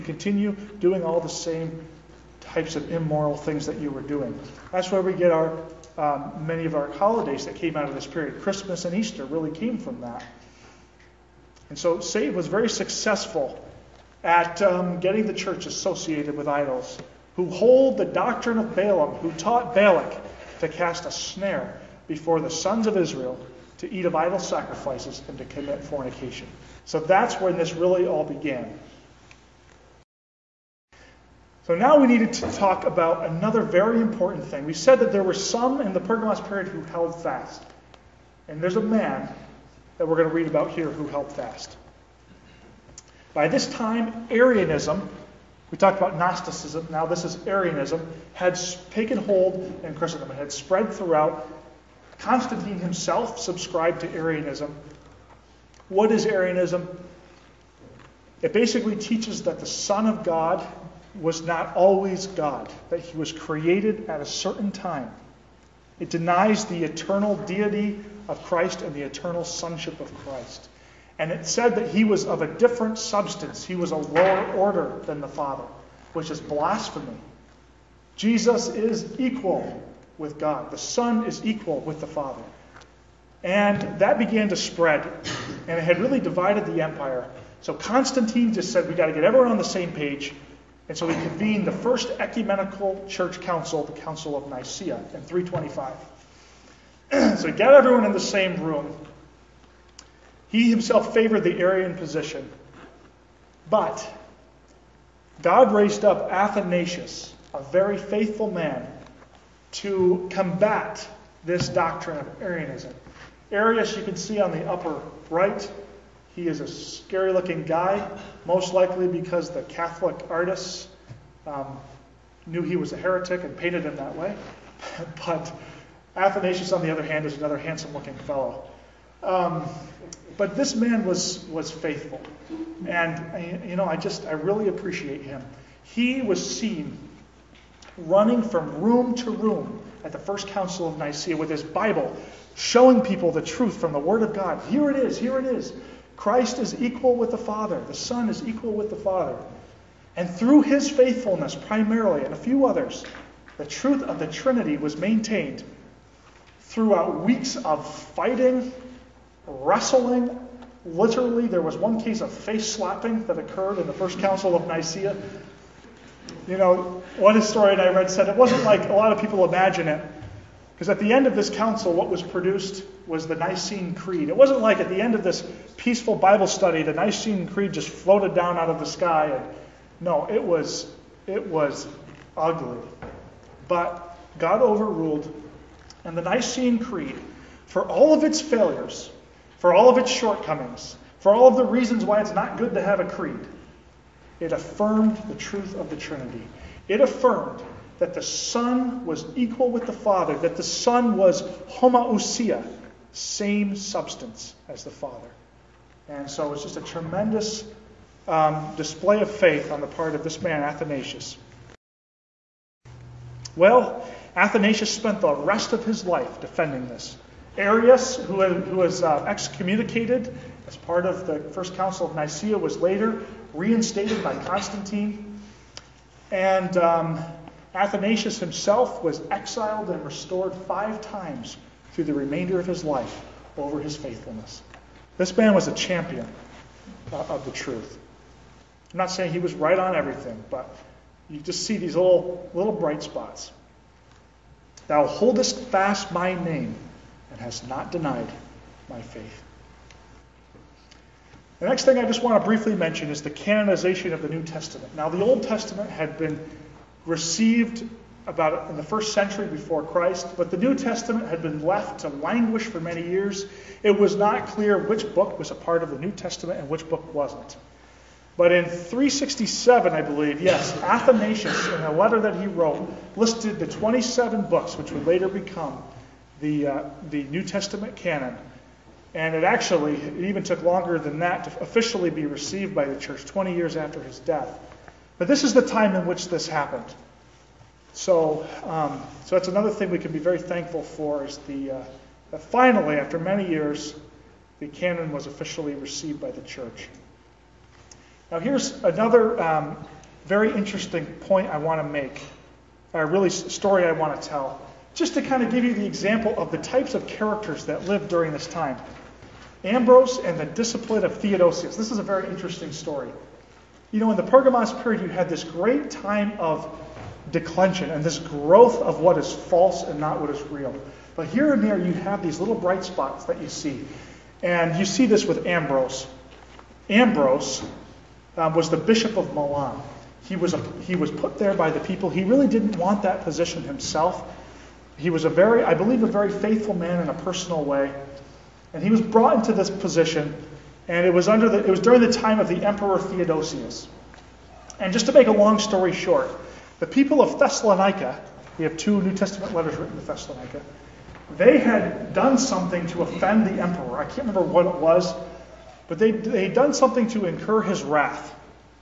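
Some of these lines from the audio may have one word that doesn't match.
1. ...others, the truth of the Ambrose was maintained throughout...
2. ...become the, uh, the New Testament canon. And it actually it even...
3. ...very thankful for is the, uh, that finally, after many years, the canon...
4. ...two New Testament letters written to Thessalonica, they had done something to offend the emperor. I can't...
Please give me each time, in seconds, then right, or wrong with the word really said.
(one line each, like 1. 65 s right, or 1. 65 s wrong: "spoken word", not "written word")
1. 152 s wrong: "Trinity", not "Ambrose"
2. 275 s right
3. 290 s right
4. 348 s right.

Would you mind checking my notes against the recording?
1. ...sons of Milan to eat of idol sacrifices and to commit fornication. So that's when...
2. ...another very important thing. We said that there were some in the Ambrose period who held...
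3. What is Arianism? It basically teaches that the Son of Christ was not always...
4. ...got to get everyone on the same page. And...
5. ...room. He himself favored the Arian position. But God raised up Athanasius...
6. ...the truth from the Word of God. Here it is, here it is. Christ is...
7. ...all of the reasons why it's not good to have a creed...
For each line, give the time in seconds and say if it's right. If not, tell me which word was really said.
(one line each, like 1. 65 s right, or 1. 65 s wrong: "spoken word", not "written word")
1. 22 s wrong: "Israel", not "Milan"
2. 33 s wrong: "Pergamos", not "Ambrose"
3. 55 s wrong: "God", not "Christ"
4. 88 s right
5. 98 s right
6. 143 s right
7. 191 s right.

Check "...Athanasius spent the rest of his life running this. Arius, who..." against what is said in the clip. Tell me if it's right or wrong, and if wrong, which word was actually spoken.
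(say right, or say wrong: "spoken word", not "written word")
wrong: "defending", not "running".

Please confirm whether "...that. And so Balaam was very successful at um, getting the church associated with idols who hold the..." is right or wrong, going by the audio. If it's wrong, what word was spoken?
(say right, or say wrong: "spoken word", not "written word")
wrong: "Save", not "Balaam".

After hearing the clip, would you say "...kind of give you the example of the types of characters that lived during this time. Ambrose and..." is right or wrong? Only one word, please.
right.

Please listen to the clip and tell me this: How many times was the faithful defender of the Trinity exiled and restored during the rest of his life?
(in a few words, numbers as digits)
5.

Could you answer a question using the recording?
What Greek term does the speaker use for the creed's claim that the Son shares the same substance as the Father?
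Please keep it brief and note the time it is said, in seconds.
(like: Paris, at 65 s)
homoousia, at 201 s.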